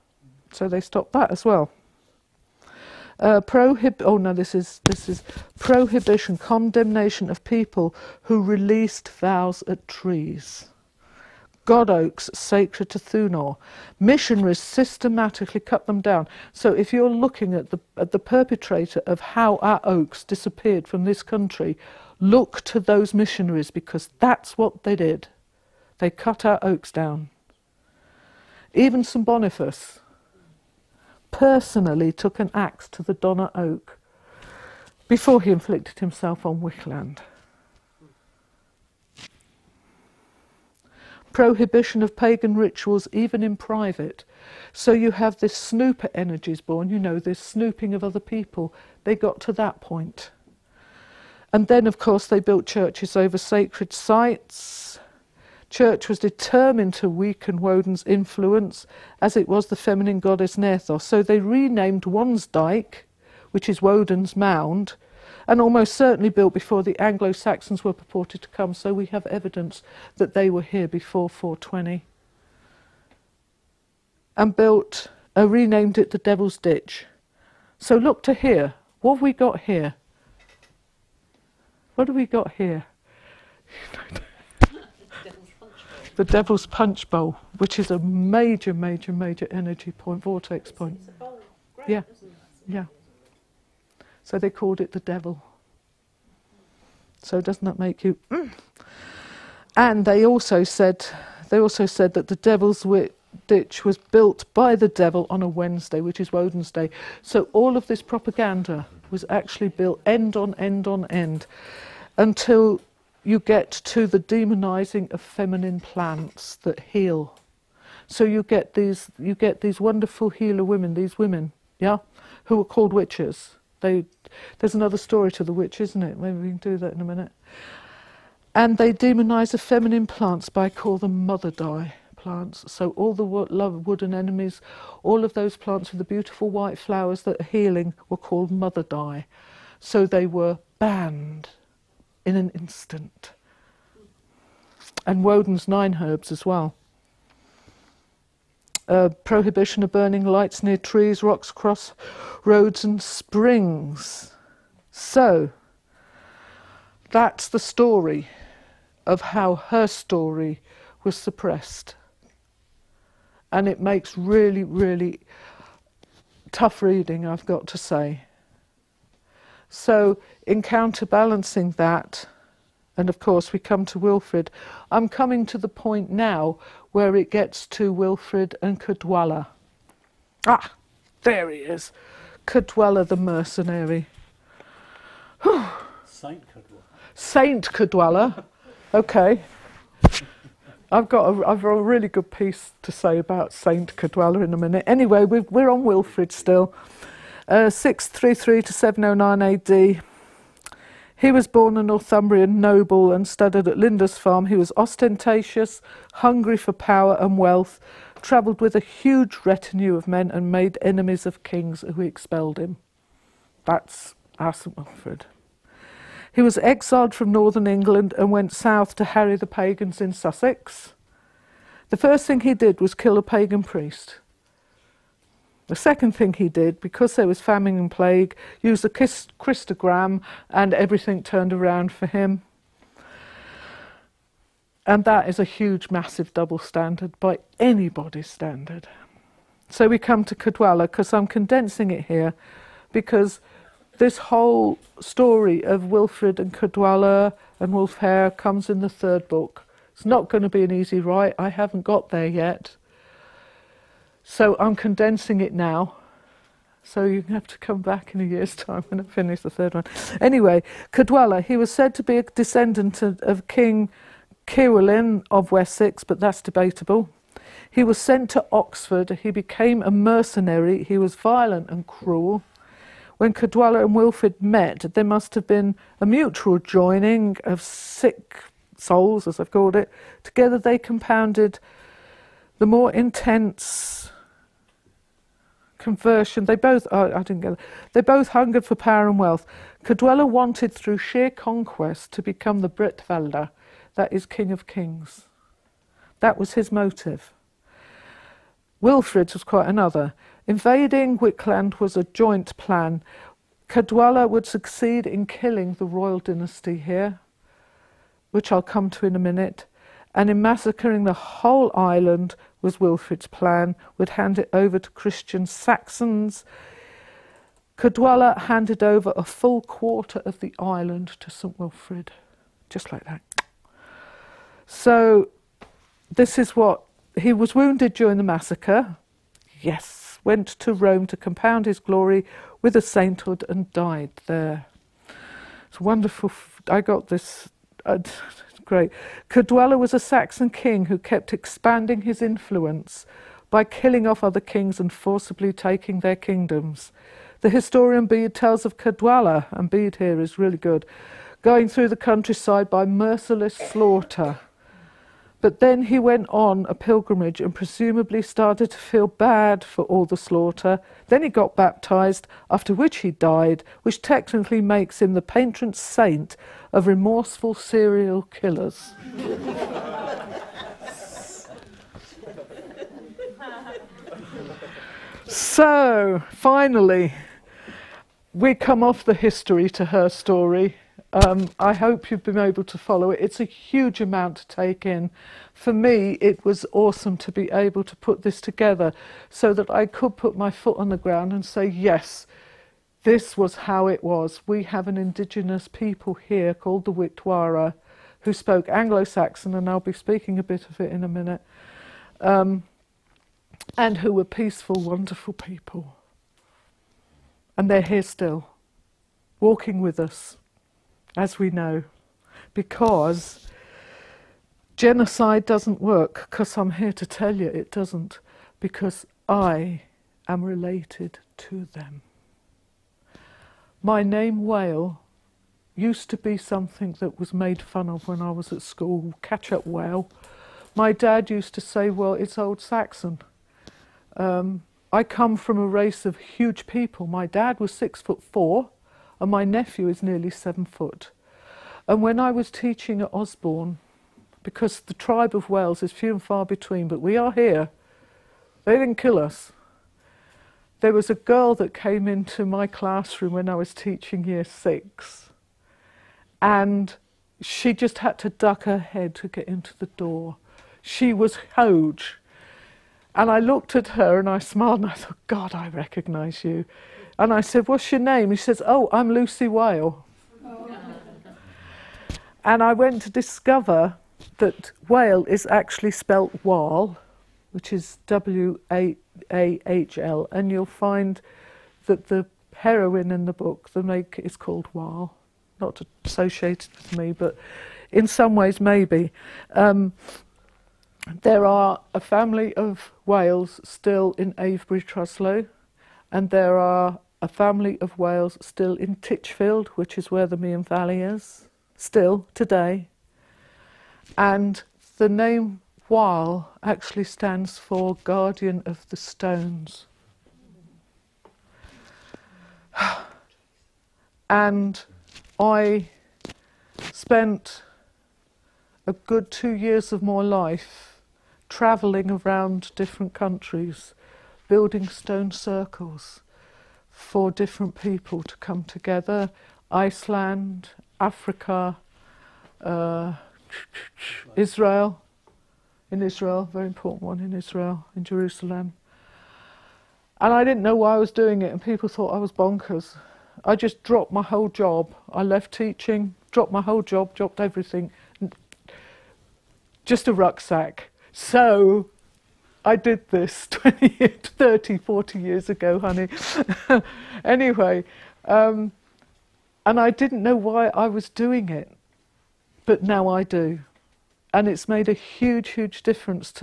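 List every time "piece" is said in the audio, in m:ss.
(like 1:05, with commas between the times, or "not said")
3:12.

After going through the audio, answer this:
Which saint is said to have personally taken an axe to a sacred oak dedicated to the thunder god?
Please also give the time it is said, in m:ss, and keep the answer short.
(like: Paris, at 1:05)
St Boniface, at 0:29.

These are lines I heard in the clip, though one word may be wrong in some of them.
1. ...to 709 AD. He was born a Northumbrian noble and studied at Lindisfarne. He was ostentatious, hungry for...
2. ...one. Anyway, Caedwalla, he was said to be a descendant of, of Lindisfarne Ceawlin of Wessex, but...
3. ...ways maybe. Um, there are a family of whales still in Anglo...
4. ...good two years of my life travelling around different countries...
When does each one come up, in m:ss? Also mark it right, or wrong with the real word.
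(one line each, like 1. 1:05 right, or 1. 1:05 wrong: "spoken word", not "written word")
1. 3:18 right
2. 4:19 wrong: "King", not "Lindisfarne"
3. 8:08 wrong: "Avebury", not "Anglo"
4. 8:38 right.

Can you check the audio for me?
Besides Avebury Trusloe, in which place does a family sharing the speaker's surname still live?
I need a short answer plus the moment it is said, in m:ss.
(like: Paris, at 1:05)
Titchfield, at 8:18.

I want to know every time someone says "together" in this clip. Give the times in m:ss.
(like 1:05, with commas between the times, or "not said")
4:40, 6:28, 8:48.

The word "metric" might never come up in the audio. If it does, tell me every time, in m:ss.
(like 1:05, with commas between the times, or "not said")
not said.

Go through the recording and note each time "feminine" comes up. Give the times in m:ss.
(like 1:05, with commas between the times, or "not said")
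0:59, 1:55, 2:09.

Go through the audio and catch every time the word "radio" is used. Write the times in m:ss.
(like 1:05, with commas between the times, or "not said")
not said.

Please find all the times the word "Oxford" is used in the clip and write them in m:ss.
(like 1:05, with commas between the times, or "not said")
4:28.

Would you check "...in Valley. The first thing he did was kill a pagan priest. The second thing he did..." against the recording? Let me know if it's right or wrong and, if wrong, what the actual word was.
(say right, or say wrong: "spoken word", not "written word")
wrong: "Sussex", not "Valley".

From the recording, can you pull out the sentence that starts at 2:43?
And it makes really, really tough reading, I've got to say.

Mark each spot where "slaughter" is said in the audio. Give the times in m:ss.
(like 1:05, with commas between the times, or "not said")
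5:53, 6:00.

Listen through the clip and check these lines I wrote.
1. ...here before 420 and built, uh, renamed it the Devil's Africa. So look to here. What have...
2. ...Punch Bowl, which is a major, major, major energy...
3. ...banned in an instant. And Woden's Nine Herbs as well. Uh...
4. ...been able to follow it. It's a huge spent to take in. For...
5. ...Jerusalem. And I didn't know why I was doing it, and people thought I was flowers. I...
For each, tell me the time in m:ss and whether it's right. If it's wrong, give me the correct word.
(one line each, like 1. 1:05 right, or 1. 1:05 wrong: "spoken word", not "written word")
1. 1:10 wrong: "Ditch", not "Africa"
2. 1:26 right
3. 2:20 right
4. 6:22 wrong: "amount", not "spent"
5. 8:58 wrong: "bonkers", not "flowers".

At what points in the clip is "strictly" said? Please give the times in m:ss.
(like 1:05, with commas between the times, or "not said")
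not said.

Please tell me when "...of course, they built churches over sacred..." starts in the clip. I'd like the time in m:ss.
0:51.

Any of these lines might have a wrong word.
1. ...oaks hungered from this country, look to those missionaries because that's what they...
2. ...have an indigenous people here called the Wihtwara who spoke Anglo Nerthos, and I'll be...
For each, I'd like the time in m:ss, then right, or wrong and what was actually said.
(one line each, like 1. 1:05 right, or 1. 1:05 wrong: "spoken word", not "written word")
1. 0:19 wrong: "disappeared", not "hungered"
2. 6:34 wrong: "Saxon", not "Nerthos".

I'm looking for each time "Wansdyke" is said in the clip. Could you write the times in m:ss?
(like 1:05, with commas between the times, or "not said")
1:02.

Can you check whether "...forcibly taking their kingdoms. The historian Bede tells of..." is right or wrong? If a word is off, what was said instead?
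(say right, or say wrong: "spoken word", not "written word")
right.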